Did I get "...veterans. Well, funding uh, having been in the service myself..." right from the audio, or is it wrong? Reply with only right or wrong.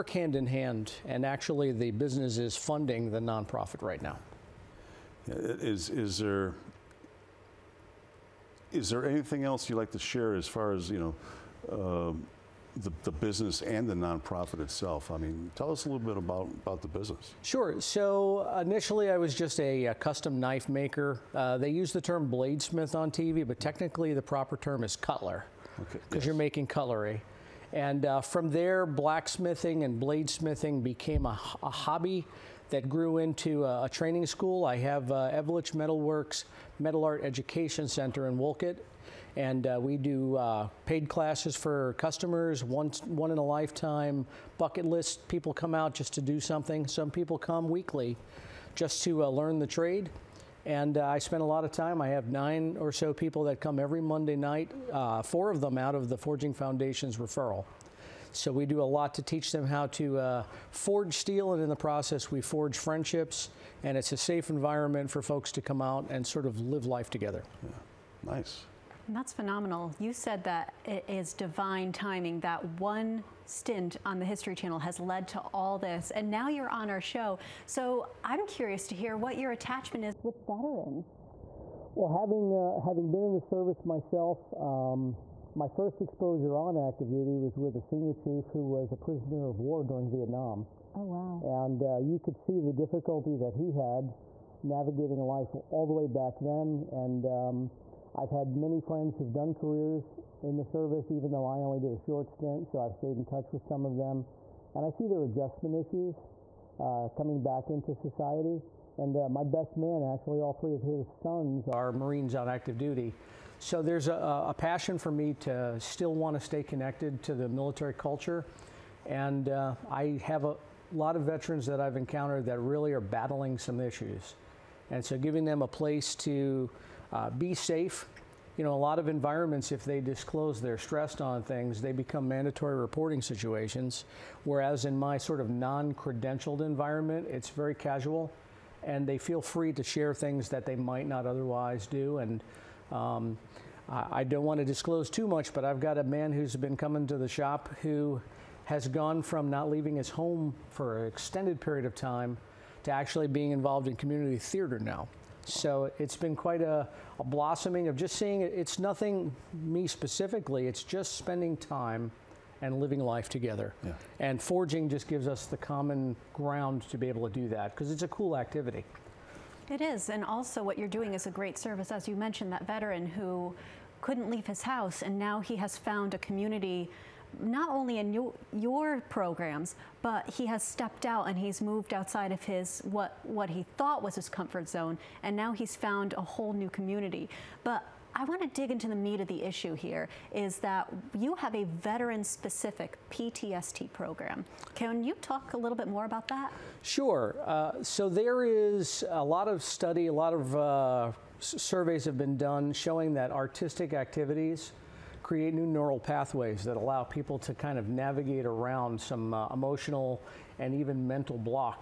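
wrong.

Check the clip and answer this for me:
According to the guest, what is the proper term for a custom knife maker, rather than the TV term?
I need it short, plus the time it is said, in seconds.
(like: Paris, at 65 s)
Cutler, at 24 s.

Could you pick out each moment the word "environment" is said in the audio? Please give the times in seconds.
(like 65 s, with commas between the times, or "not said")
64 s, 129 s, 136 s.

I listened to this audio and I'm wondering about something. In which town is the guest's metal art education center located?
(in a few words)
Wolcott.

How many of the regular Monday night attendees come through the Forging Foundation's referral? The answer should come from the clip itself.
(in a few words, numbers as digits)
4.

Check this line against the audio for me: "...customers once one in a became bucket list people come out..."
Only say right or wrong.
wrong.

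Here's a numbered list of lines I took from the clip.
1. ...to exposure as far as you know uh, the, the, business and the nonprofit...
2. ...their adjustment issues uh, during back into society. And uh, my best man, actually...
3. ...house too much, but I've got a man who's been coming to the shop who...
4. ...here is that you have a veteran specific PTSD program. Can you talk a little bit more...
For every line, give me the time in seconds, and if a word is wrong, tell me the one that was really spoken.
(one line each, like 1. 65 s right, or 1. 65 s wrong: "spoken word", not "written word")
1. 9 s wrong: "share", not "exposure"
2. 105 s wrong: "coming", not "during"
3. 144 s wrong: "disclose", not "house"
4. 189 s right.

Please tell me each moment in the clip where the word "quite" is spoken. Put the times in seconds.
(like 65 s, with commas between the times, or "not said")
156 s.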